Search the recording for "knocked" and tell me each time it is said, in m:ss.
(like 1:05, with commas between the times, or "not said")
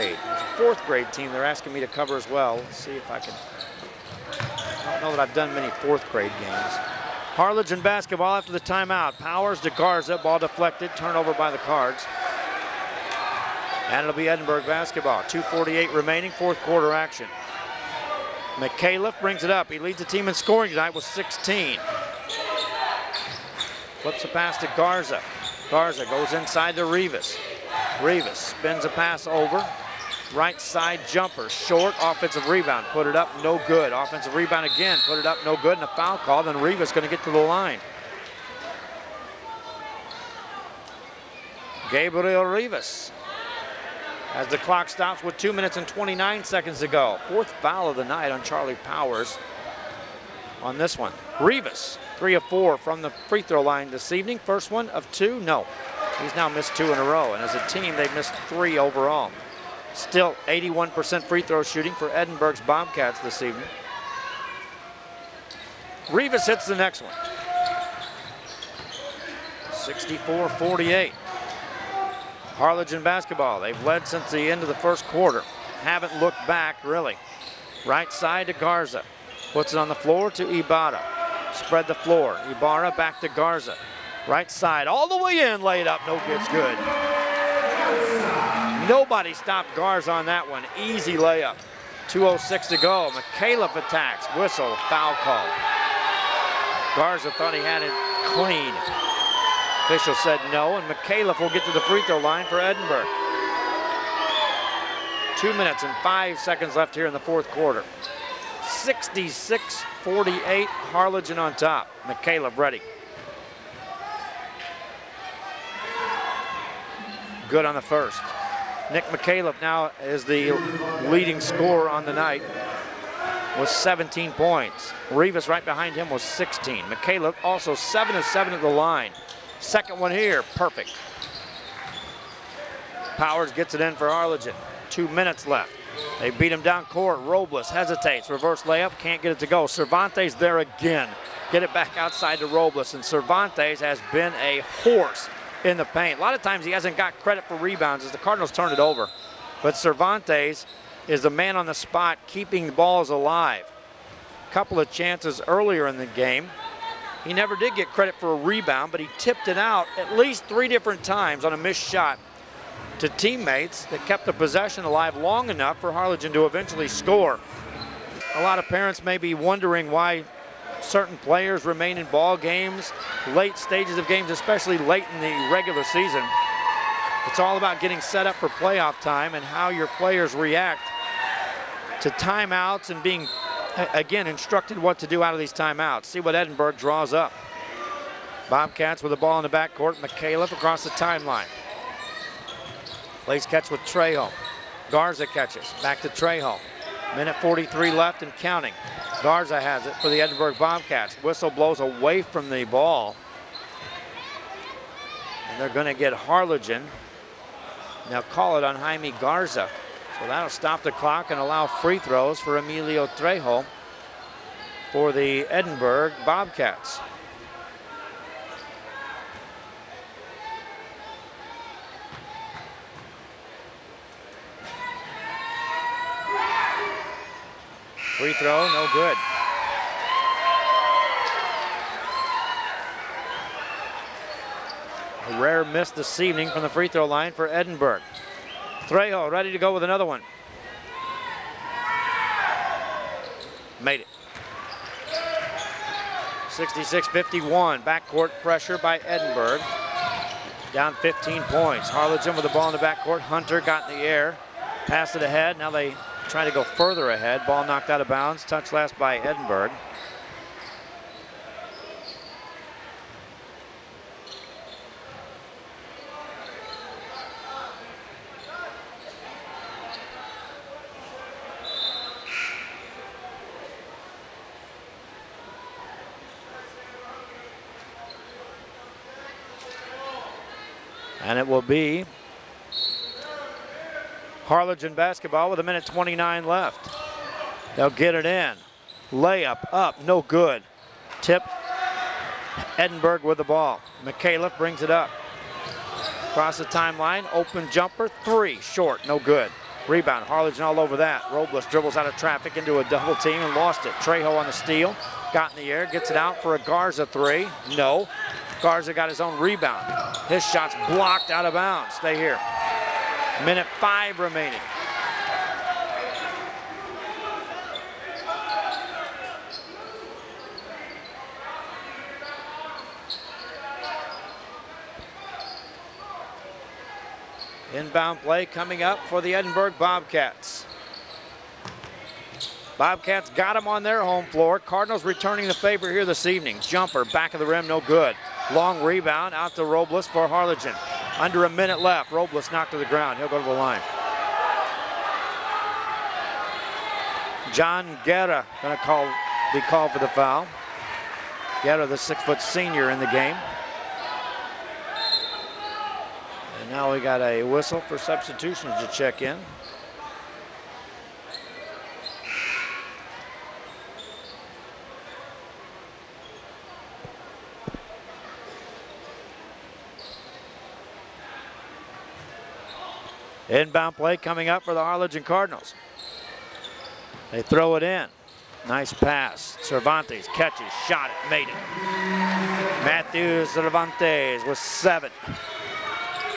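4:17, 5:42.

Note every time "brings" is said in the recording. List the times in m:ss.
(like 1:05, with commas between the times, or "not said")
0:19, 4:54.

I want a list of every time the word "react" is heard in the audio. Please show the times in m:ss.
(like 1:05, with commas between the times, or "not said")
3:00.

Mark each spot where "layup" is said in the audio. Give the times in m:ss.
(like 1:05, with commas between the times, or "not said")
1:31, 2:18, 4:49.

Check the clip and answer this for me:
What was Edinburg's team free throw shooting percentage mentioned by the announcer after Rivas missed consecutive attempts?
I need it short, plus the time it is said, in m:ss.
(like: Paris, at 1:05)
81%, at 1:00.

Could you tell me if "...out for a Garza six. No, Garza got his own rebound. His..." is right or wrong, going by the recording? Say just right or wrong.
wrong.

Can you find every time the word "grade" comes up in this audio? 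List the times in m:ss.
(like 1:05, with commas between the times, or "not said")
0:00, 0:06.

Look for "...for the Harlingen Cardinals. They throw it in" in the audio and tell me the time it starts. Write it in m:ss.
6:14.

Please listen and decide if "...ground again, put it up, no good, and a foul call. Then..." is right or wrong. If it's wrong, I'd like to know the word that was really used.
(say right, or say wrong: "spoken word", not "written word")
wrong: "rebound", not "ground".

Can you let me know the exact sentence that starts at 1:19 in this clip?
Puts it on the floor to Ibarra.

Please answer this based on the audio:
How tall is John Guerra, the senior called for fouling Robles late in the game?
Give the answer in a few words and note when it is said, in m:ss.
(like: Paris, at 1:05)
6 feet, at 5:51.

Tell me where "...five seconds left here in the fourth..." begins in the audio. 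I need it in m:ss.
1:46.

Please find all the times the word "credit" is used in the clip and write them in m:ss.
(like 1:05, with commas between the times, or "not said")
2:27, 2:37.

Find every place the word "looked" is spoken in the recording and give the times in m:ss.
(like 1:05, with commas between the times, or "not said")
1:16.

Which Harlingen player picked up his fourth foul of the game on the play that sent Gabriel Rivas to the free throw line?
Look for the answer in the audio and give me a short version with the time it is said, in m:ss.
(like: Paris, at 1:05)
Charlie Powers, at 0:48.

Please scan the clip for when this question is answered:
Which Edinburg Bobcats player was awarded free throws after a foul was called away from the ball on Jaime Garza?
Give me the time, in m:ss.
3:32.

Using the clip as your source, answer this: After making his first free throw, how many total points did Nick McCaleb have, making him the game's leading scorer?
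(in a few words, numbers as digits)
17.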